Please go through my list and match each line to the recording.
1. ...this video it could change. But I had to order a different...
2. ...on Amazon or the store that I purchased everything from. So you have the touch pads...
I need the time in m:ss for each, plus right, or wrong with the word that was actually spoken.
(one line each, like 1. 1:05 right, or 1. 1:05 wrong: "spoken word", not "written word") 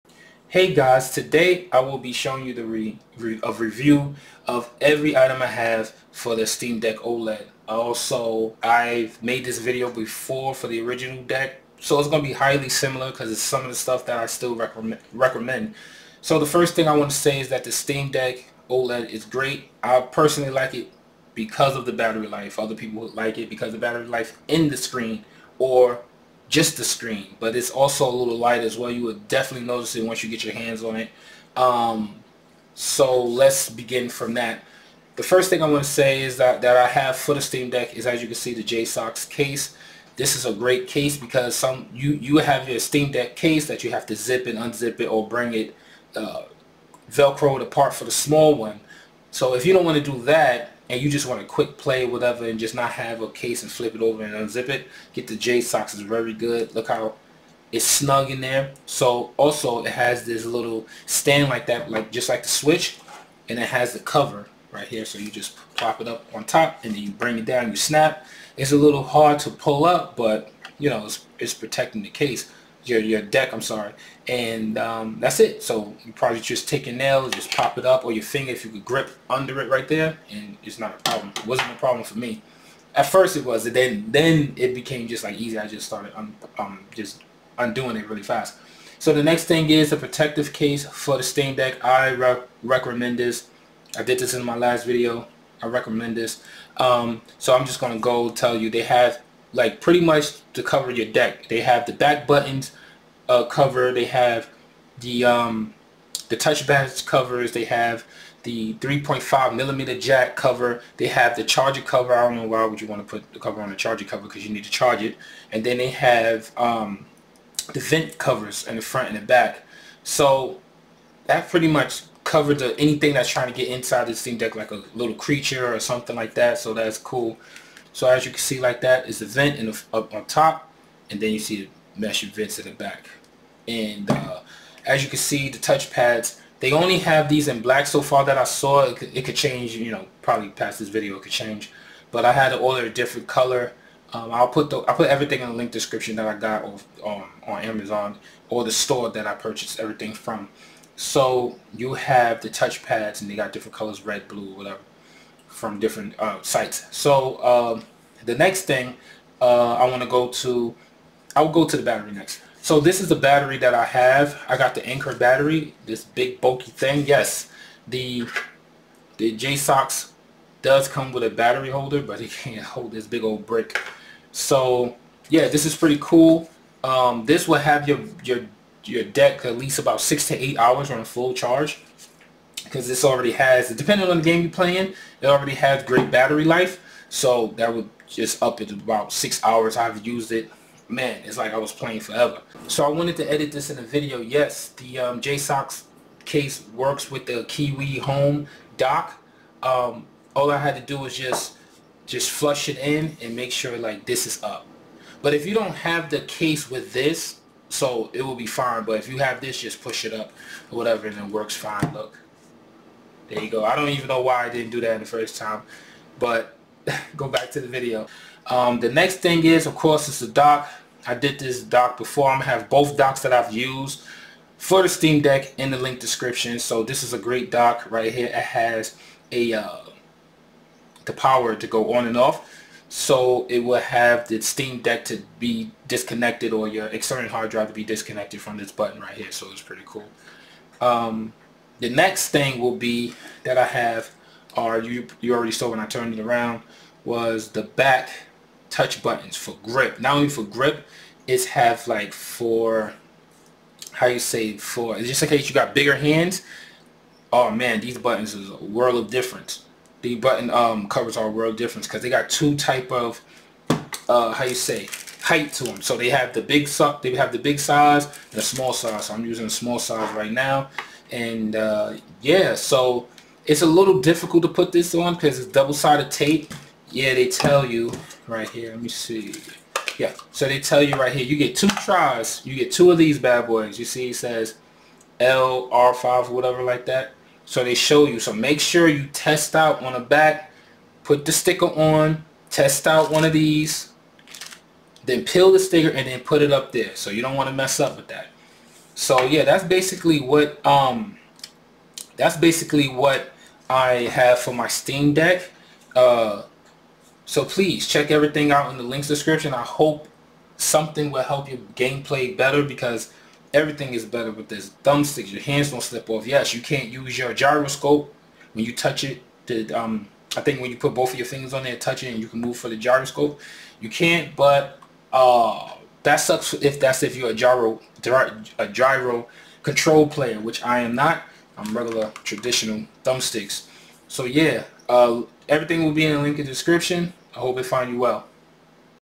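1. 2:20 right
2. 2:27 right.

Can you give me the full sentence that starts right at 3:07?
So that would just up it about six hours I've used it.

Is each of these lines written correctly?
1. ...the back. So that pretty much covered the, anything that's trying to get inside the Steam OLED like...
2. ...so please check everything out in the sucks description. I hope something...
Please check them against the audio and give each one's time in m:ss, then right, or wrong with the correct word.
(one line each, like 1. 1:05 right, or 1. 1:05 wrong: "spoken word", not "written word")
1. 1:59 wrong: "Deck", not "OLED"
2. 5:07 wrong: "links", not "sucks".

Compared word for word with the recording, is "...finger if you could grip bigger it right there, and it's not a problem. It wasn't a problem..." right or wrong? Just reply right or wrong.
wrong.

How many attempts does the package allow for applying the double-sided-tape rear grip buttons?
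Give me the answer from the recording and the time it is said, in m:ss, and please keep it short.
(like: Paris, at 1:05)
2, at 4:41.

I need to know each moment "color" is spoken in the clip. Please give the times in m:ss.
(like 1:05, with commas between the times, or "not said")
2:23, 2:33.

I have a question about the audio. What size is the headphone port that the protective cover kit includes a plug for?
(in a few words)
3.5 millimeter.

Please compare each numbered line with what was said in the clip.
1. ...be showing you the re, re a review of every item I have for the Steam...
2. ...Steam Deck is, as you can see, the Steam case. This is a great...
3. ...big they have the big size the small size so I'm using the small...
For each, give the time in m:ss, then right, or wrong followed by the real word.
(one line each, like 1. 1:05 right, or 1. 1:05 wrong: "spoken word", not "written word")
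1. 0:01 right
2. 0:37 wrong: "JSAUX", not "Steam"
3. 4:26 right.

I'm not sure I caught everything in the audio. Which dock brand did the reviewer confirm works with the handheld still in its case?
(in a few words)
KiwiHome.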